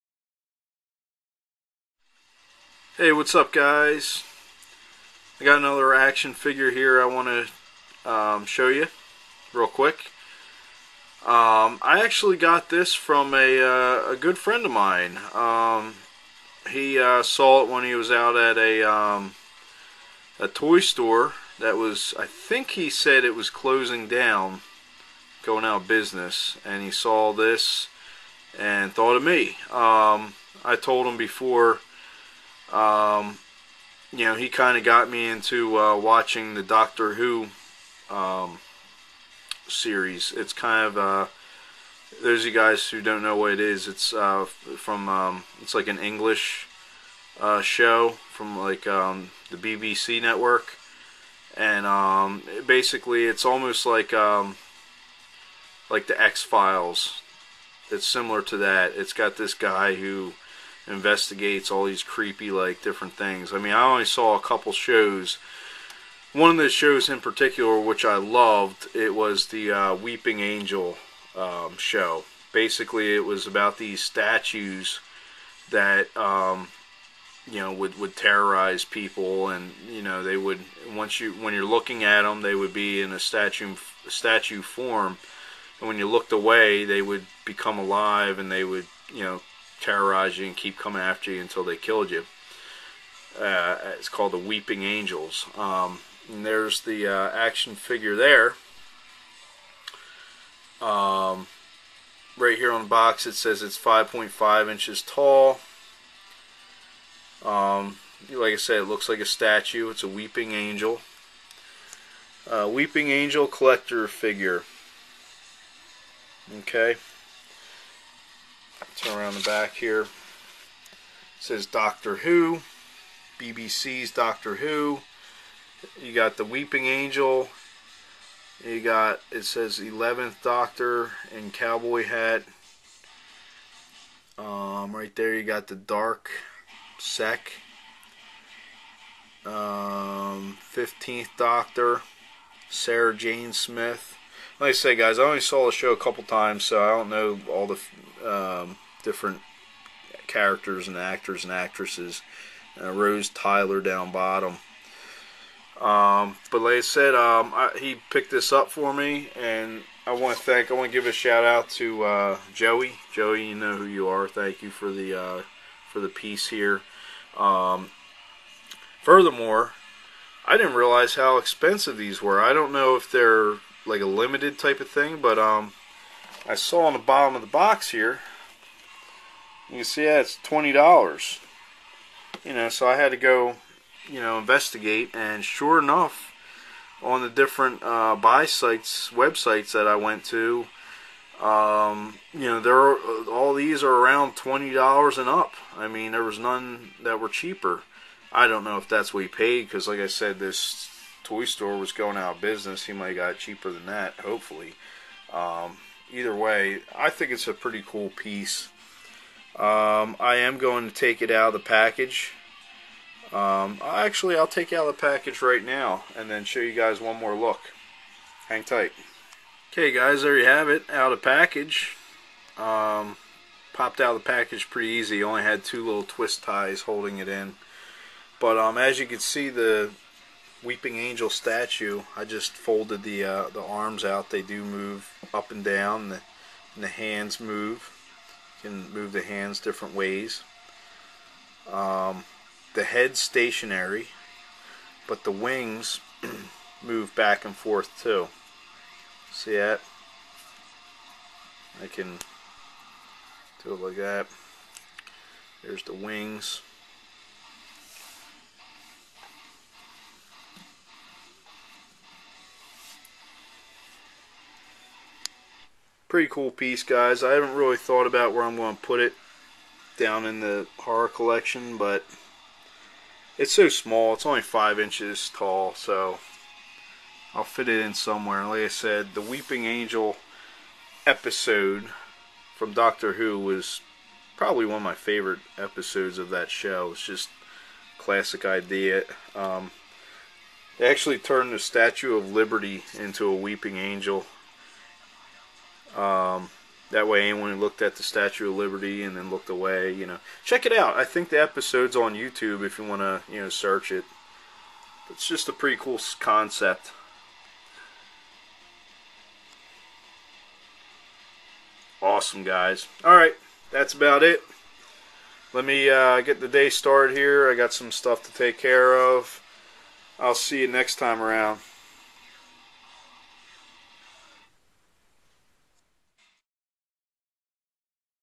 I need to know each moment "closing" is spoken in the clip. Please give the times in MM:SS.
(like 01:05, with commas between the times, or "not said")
00:23.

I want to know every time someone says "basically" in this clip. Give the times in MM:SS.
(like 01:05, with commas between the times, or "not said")
00:52, 01:12.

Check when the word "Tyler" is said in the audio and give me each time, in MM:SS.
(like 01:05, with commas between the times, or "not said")
02:33.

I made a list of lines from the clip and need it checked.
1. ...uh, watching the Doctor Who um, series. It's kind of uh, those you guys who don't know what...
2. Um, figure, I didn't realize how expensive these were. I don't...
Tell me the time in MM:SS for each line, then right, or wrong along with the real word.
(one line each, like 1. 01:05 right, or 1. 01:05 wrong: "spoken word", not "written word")
1. 00:35 right
2. 02:47 wrong: "furthermore", not "figure".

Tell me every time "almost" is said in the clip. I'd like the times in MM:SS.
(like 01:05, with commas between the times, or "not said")
00:53.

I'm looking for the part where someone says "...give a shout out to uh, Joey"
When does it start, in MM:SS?
02:40.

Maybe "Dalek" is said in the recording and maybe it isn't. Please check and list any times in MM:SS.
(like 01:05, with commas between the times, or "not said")
02:15.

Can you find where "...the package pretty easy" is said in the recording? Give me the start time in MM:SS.
03:44.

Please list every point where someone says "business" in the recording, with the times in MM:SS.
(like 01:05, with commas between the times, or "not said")
00:25, 03:22.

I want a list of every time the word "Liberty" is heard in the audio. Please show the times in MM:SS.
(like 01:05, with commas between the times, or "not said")
04:52, 04:58.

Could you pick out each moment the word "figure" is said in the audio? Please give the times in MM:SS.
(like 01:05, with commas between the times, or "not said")
00:06, 01:37, 01:54.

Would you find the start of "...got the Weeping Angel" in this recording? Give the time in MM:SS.
02:06.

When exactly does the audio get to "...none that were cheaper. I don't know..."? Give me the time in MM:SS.
03:16.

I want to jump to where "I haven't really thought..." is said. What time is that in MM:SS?
04:27.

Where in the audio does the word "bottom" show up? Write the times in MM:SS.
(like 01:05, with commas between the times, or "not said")
02:34, 02:56.